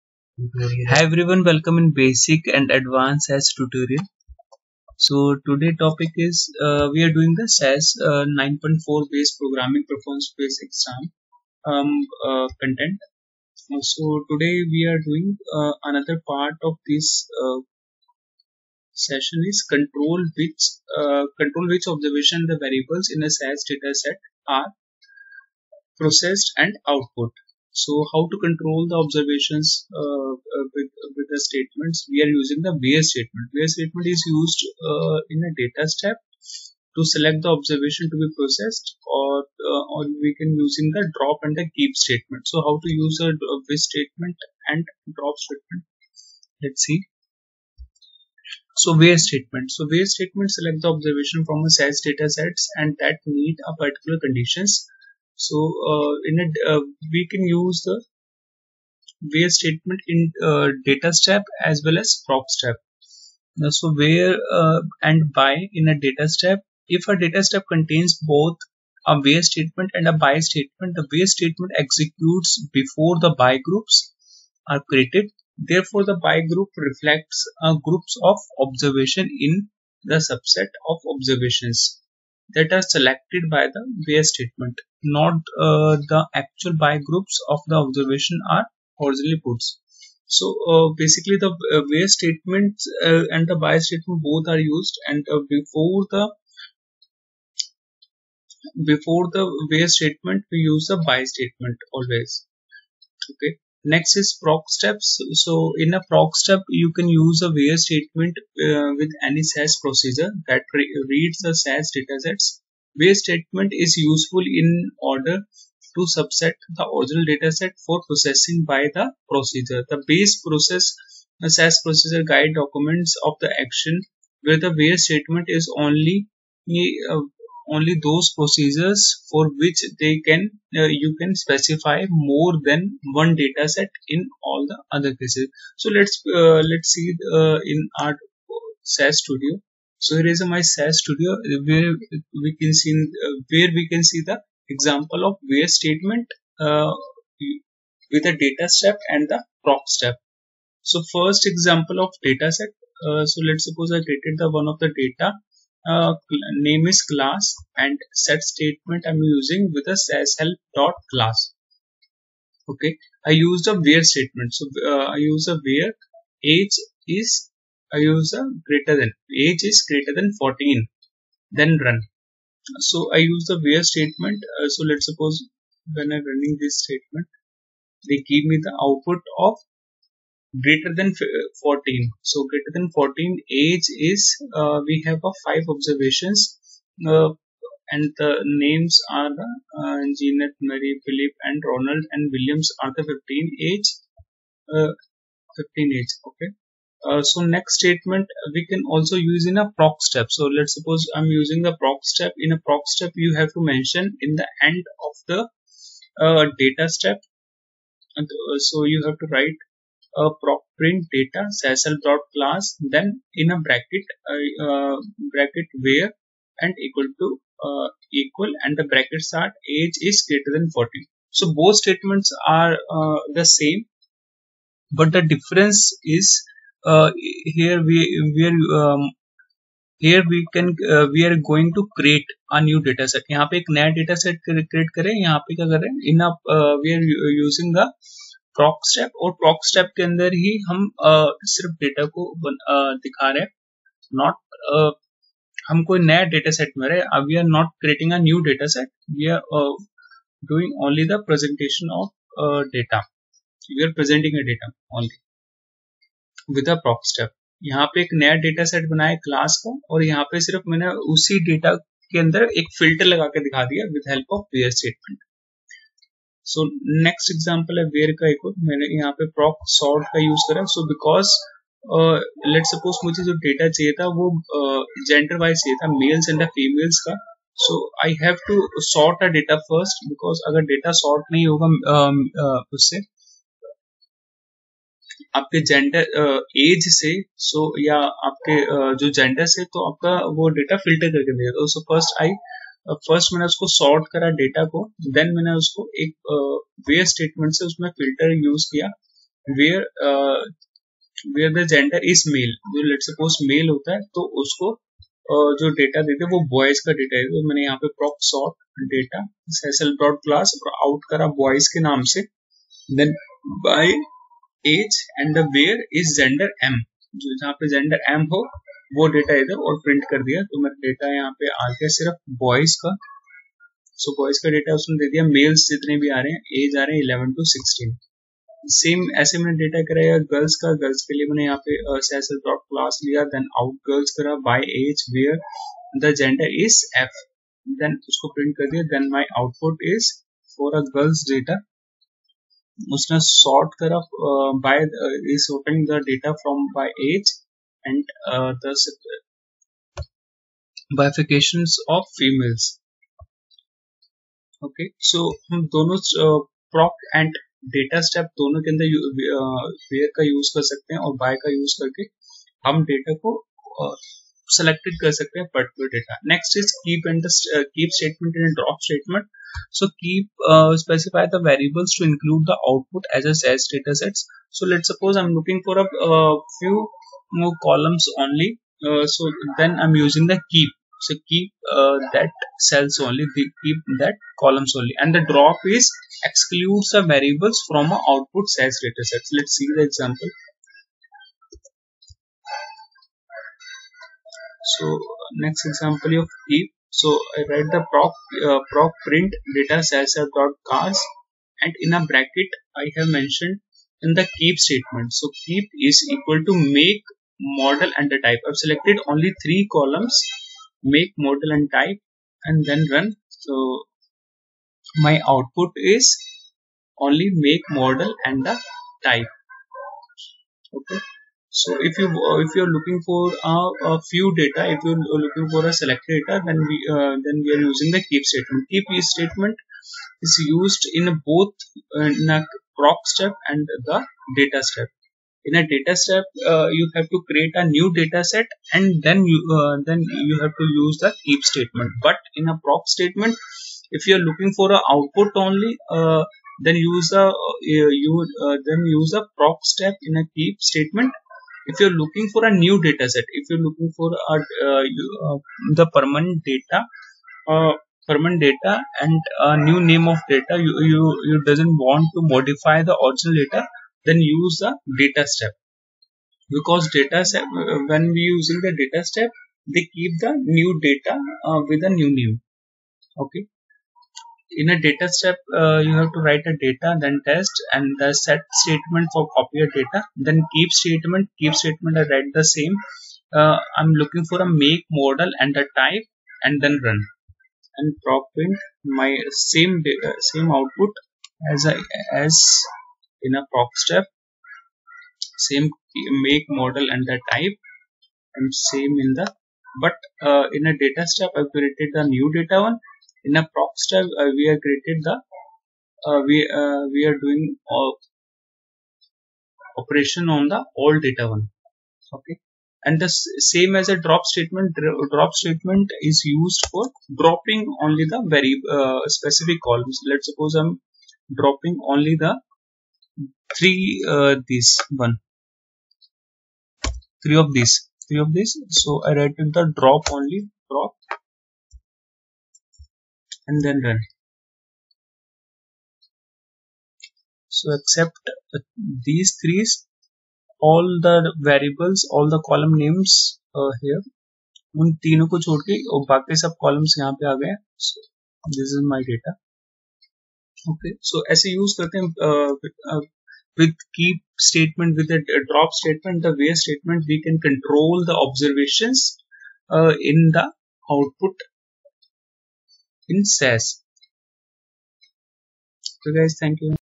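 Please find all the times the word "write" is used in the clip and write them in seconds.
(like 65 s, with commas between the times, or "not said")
209 s, 397 s, 476 s, 482 s, 529 s.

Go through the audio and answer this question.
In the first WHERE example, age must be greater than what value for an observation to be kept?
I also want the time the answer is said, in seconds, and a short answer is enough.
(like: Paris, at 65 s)
14, at 169 s.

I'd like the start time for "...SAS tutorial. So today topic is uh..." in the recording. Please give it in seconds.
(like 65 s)
3 s.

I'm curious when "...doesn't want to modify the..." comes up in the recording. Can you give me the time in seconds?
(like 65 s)
461 s.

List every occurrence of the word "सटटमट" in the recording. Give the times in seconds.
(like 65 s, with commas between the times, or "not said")
264 s, 297 s.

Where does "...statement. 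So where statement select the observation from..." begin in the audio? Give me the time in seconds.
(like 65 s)
49 s.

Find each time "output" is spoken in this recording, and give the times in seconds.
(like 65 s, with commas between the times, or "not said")
26 s, 178 s, 372 s, 388 s, 415 s, 444 s, 490 s, 560 s.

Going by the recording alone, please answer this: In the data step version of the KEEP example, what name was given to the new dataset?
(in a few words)
test.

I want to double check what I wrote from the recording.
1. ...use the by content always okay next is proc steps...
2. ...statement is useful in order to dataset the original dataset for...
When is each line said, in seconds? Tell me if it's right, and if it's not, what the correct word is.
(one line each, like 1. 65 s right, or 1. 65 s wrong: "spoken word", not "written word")
1. 100 s wrong: "statement", not "content"
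2. 113 s wrong: "subset", not "dataset".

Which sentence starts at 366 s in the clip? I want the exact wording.
Next is keep and the uh, keep statement and drop statement.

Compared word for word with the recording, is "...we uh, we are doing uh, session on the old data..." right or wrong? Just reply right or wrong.
wrong.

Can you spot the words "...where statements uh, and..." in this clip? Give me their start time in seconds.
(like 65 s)
91 s.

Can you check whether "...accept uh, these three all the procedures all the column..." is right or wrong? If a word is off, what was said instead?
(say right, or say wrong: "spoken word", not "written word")
wrong: "variables", not "procedures".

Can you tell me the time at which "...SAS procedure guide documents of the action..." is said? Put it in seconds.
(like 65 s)
121 s.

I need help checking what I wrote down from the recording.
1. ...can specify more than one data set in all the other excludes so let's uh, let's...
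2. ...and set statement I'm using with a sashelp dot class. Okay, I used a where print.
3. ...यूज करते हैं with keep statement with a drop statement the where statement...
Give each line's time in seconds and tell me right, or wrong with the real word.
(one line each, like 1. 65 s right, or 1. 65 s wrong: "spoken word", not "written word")
1. 131 s wrong: "cases", not "excludes"
2. 157 s wrong: "statement", not "print"
3. 551 s right.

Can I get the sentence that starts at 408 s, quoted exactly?
I've selected only three columns, make model and type and then run.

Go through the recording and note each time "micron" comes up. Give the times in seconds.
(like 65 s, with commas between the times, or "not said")
not said.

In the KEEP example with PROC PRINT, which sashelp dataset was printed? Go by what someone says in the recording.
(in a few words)
cars.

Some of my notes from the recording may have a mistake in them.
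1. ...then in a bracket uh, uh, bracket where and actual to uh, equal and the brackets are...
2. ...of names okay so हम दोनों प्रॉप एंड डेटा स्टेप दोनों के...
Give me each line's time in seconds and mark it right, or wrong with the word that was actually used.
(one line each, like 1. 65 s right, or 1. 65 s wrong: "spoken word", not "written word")
1. 212 s wrong: "equal", not "actual"
2. 351 s wrong: "females", not "names".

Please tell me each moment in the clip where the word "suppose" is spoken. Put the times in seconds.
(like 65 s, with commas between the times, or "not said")
153 s, 175 s, 200 s, 374 s, 520 s.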